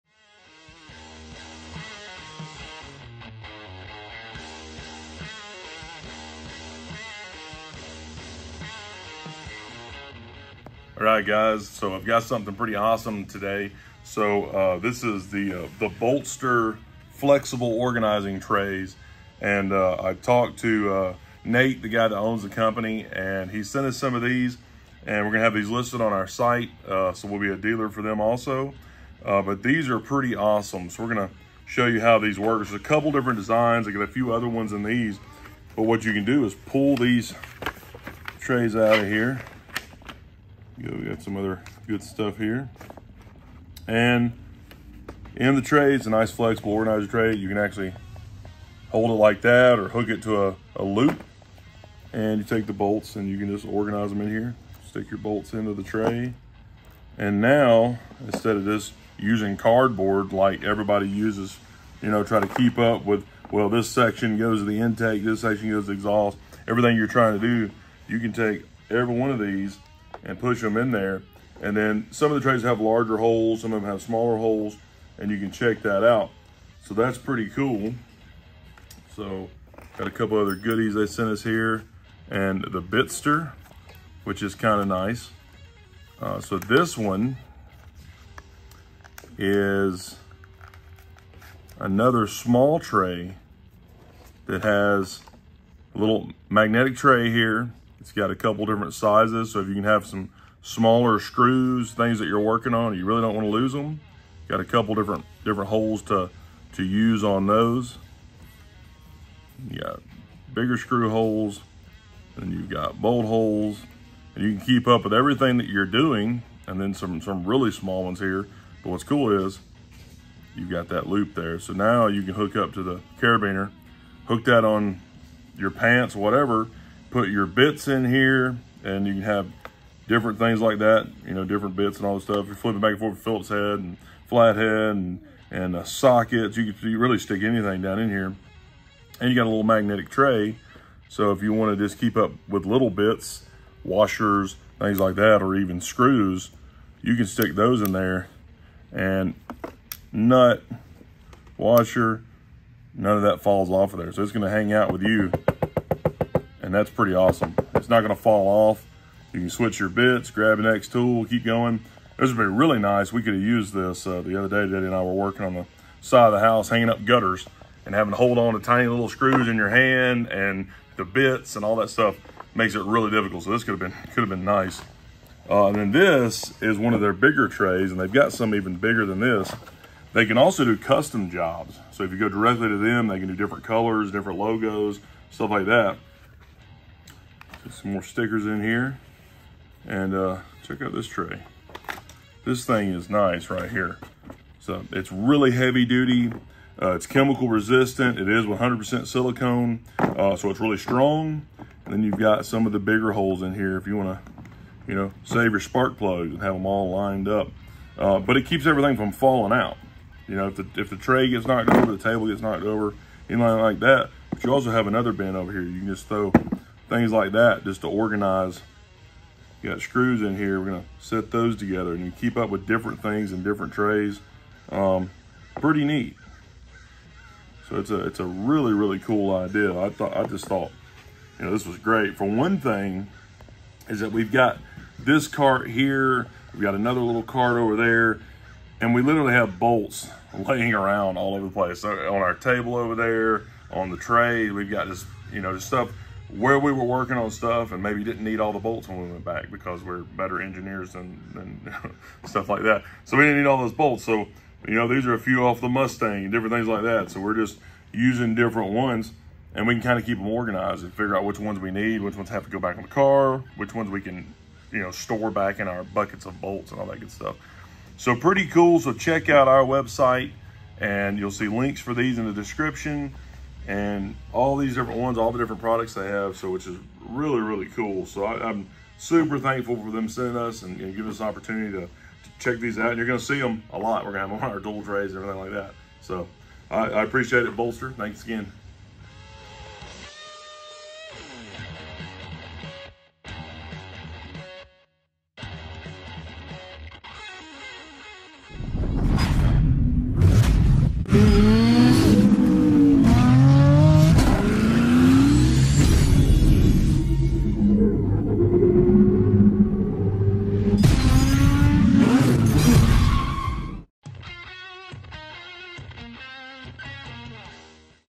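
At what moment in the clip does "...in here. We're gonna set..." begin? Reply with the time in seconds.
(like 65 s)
220 s.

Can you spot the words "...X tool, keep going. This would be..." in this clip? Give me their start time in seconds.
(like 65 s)
160 s.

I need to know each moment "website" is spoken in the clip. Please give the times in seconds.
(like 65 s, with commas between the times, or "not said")
269 s.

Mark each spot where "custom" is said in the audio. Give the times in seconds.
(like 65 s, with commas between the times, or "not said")
180 s.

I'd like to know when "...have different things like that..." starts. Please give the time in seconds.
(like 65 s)
129 s.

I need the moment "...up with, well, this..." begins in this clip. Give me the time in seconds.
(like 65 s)
62 s.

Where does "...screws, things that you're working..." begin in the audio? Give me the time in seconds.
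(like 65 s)
101 s.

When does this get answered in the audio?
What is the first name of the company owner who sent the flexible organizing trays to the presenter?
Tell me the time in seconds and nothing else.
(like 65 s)
21 s.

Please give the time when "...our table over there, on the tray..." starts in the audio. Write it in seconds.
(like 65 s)
242 s.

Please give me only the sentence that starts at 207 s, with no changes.
Uh, but it keeps everything from falling out.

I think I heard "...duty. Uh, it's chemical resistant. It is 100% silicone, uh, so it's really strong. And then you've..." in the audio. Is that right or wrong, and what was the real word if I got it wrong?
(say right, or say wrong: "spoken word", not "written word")
right.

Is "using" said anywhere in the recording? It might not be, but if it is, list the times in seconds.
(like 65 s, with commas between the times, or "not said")
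59 s, 257 s.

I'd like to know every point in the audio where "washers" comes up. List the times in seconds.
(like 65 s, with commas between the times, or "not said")
143 s, 151 s.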